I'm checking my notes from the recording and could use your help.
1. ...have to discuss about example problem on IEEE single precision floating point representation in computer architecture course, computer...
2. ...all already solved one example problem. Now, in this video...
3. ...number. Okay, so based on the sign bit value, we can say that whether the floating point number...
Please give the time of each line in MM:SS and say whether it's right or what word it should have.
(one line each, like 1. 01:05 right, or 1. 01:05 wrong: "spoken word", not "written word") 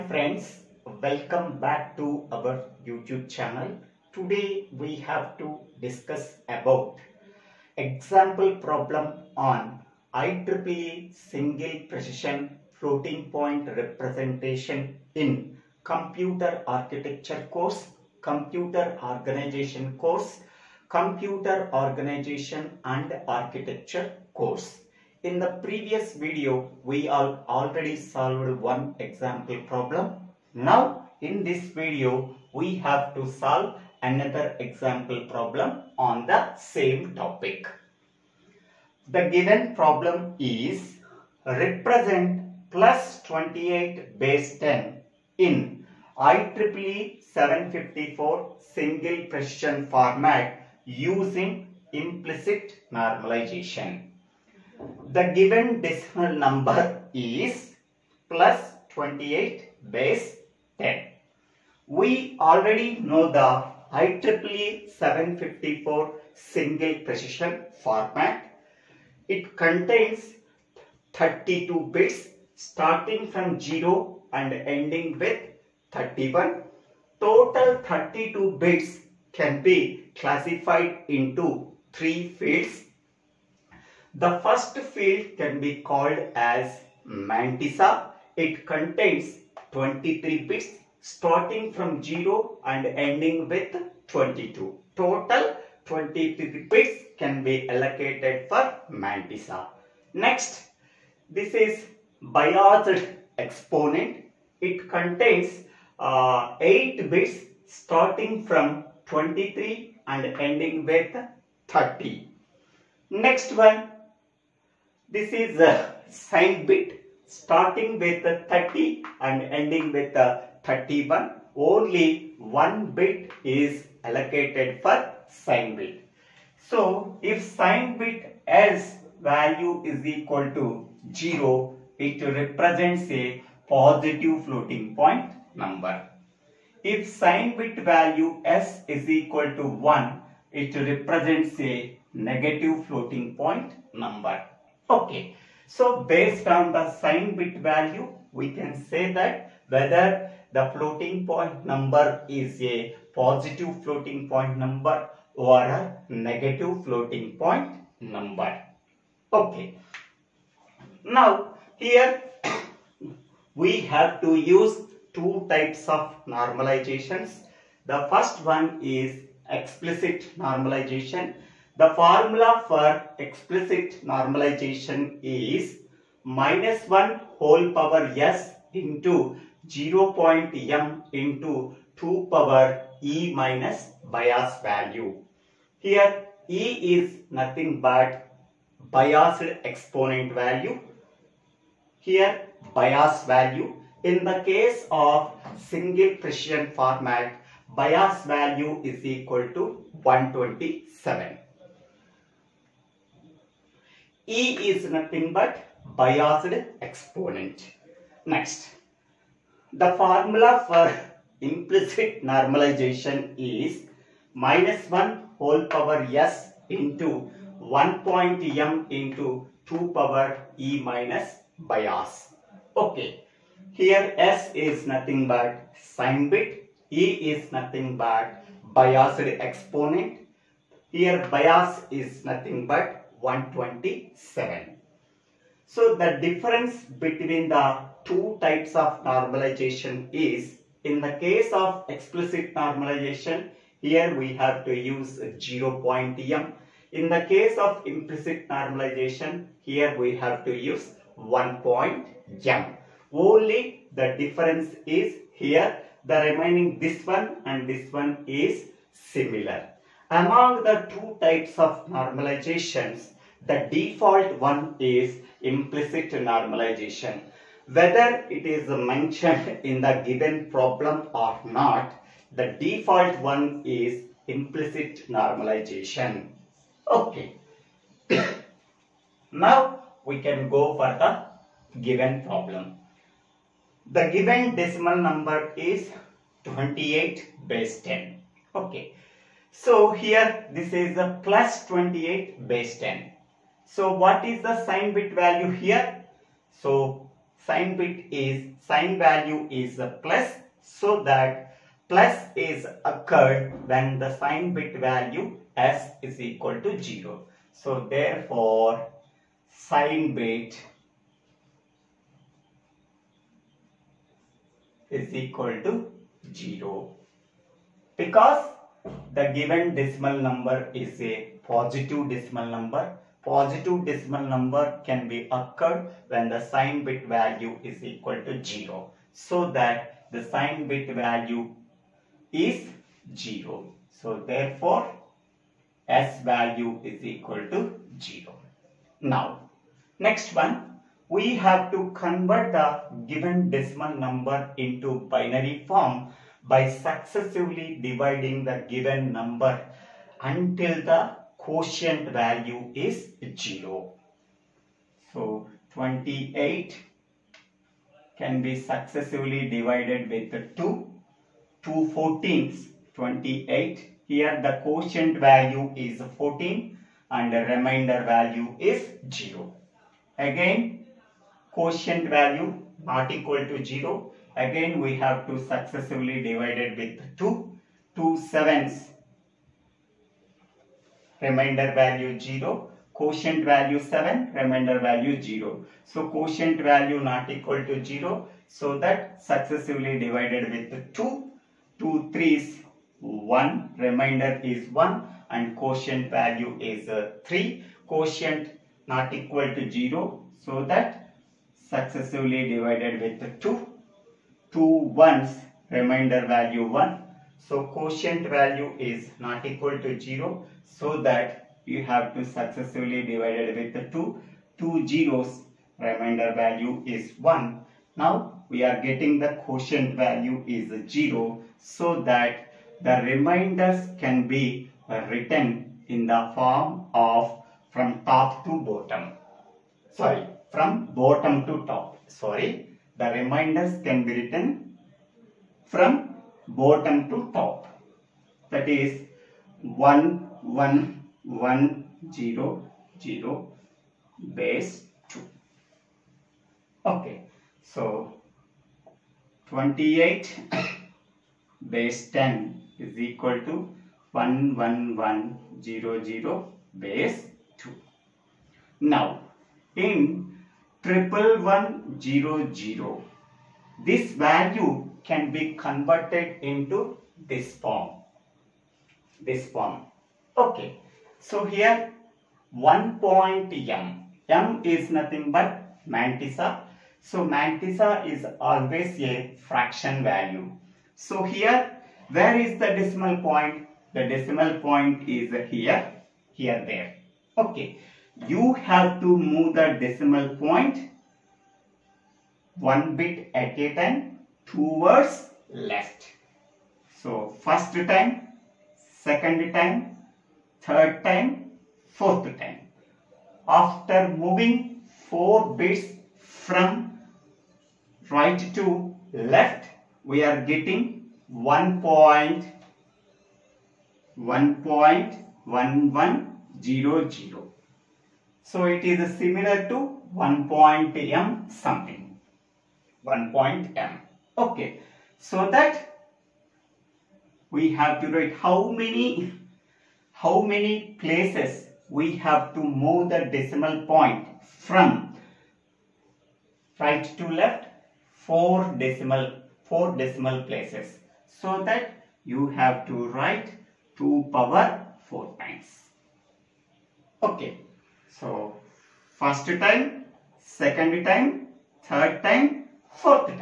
1. 00:05 right
2. 00:27 right
3. 02:23 right.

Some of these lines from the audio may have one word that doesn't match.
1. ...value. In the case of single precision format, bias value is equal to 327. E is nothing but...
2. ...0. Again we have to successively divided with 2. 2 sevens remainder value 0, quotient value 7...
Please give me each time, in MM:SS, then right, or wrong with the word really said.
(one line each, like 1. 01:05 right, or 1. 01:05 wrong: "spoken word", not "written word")
1. 03:13 wrong: "127", not "327"
2. 06:13 right.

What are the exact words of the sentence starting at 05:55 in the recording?
So 28 can be successively divided with 2.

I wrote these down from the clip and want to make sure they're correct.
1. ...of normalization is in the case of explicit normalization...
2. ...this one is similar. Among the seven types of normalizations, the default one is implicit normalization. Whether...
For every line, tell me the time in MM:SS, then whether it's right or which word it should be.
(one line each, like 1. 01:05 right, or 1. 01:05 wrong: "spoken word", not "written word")
1. 03:58 right
2. 04:17 wrong: "two", not "seven".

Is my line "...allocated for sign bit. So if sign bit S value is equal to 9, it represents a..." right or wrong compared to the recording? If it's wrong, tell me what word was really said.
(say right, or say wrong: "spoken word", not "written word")
wrong: "0", not "9".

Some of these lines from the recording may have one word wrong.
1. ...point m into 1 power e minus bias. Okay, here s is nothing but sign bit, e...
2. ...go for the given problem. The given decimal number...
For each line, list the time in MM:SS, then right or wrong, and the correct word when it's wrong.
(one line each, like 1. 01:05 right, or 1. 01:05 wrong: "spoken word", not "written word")
1. 03:38 wrong: "2", not "1"
2. 04:40 right.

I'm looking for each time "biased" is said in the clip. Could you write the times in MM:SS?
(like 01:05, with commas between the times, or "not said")
01:42, 03:08, 03:25, 03:48.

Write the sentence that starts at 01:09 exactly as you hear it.
It contains 32 bits starting from 0 and ending with 31.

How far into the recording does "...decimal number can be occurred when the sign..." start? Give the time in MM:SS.
05:23.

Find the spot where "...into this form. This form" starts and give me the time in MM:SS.
07:46.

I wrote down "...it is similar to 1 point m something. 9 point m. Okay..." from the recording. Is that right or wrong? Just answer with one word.
wrong.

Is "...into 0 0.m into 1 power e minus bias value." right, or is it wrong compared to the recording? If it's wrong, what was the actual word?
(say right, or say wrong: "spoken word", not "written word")
wrong: "2", not "1".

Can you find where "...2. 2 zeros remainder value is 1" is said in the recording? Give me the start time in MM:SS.
06:53.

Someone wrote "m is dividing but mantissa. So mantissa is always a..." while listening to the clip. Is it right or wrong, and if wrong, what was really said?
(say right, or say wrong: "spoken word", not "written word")
wrong: "nothing", not "dividing".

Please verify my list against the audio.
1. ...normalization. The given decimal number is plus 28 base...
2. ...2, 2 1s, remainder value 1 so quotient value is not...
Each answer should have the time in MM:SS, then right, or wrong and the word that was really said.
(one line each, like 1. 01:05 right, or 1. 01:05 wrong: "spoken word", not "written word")
1. 00:52 right
2. 06:43 right.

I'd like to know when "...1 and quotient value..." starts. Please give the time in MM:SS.
06:34.